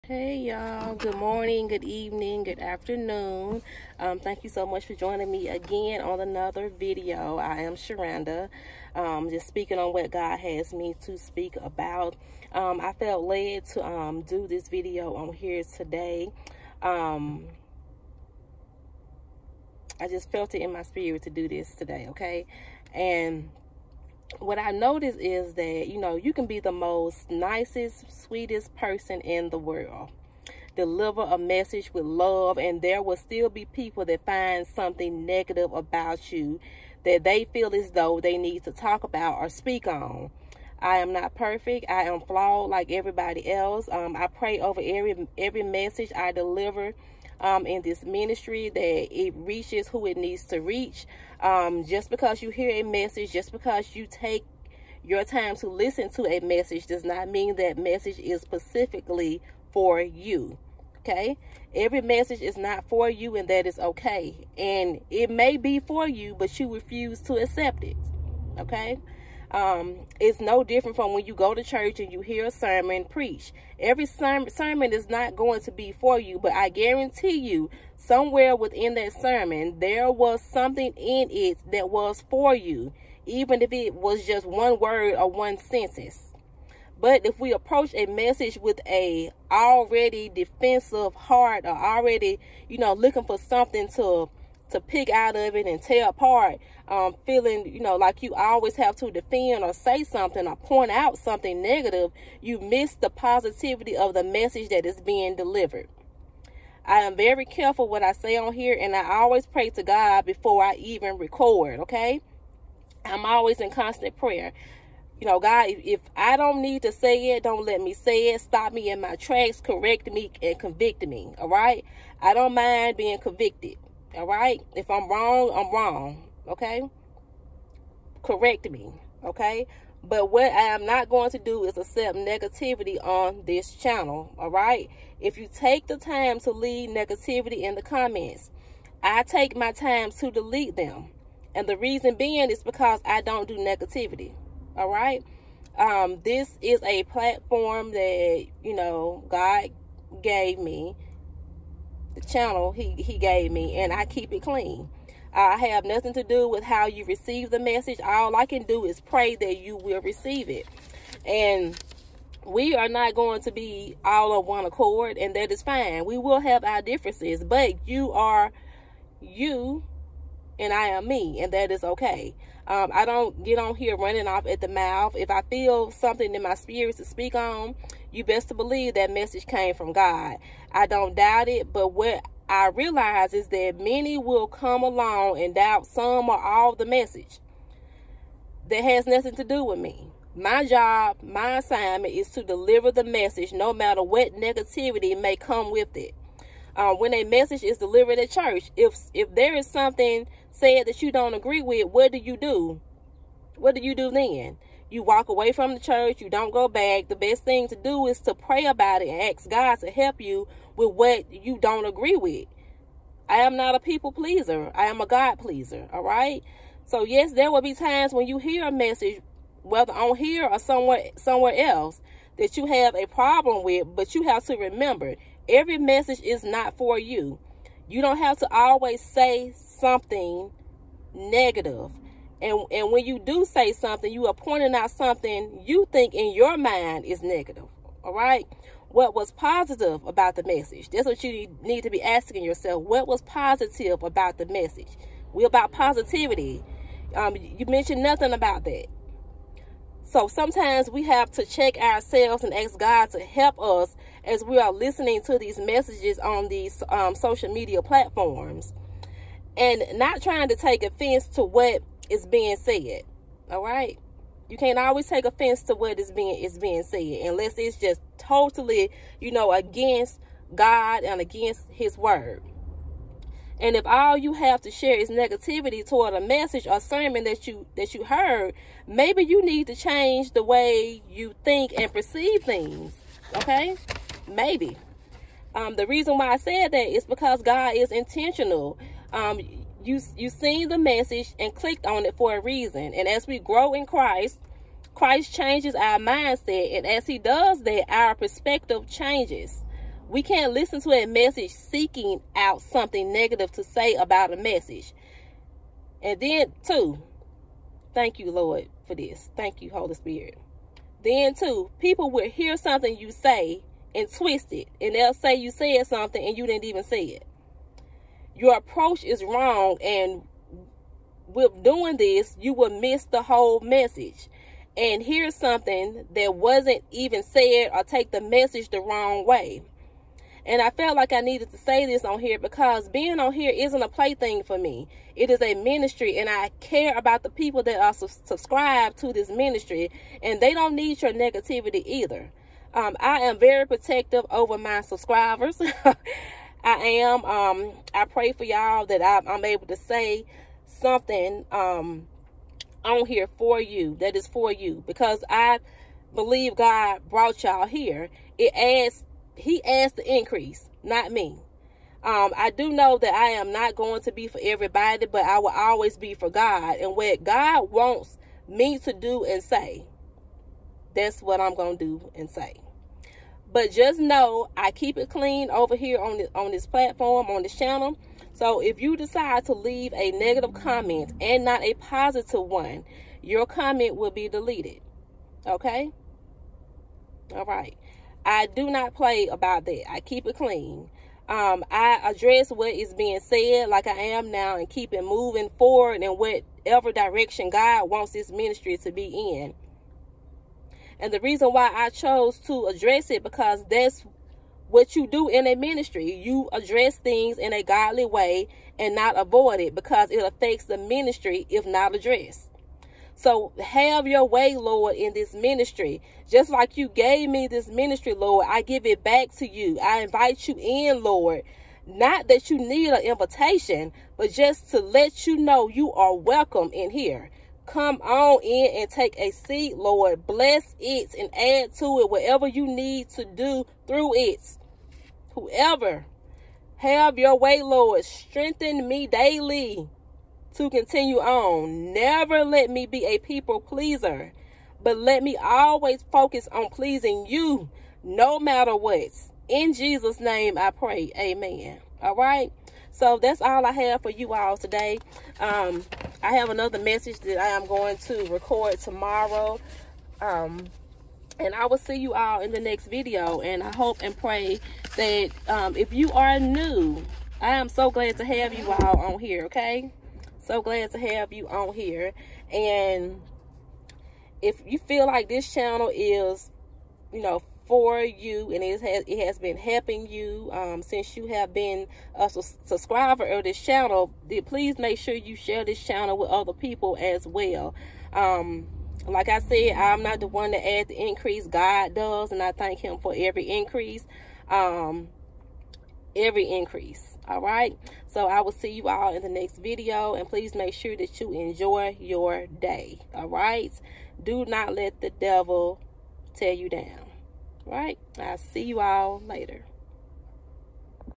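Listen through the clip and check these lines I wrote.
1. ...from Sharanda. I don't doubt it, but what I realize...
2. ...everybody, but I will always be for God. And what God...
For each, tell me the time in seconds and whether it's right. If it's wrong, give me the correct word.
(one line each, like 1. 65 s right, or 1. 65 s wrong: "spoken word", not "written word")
1. 179 s wrong: "God", not "Sharanda"
2. 364 s right.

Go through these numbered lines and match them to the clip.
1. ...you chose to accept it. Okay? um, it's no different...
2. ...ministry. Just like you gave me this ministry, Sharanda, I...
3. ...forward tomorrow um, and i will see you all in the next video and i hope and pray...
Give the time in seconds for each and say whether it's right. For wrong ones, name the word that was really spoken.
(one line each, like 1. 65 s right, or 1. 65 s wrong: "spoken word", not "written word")
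1. 66 s wrong: "refuse", not "chose"
2. 415 s wrong: "Lord", not "Sharanda"
3. 458 s wrong: "record", not "forward".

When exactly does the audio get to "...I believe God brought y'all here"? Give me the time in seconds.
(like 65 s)
355 s.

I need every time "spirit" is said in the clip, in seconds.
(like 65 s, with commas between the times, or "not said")
20 s, 176 s, 309 s.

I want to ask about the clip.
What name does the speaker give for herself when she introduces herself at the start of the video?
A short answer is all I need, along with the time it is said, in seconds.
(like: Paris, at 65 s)
Sharanda, at 7 s.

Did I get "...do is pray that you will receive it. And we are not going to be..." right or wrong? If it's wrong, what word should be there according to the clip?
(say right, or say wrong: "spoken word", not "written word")
right.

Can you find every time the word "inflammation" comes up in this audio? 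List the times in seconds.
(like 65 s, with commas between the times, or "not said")
not said.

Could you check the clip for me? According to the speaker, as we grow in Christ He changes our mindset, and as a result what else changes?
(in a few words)
our perspective.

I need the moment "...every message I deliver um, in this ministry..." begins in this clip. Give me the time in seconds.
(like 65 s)
45 s.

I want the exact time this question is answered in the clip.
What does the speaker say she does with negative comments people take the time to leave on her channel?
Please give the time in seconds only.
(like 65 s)
140 s.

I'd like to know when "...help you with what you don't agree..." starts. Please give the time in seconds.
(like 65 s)
209 s.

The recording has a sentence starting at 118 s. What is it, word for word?
Stop me in my tracks, correct me, and convict me, all right?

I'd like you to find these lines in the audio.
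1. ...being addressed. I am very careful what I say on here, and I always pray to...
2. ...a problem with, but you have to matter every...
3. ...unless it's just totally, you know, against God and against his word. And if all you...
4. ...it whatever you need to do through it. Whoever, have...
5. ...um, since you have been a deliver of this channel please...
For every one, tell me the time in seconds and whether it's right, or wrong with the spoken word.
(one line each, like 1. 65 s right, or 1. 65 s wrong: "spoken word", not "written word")
1. 105 s wrong: "delivered", not "addressed"
2. 222 s wrong: "remember", not "matter"
3. 267 s right
4. 431 s right
5. 480 s wrong: "subscriber", not "deliver".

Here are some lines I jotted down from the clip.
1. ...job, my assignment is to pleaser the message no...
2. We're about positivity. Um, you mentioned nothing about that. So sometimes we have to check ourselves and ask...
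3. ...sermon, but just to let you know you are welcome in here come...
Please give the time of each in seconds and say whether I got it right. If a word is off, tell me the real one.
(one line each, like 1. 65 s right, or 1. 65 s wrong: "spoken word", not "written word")
1. 190 s wrong: "deliver", not "pleaser"
2. 245 s right
3. 423 s wrong: "invitation", not "sermon".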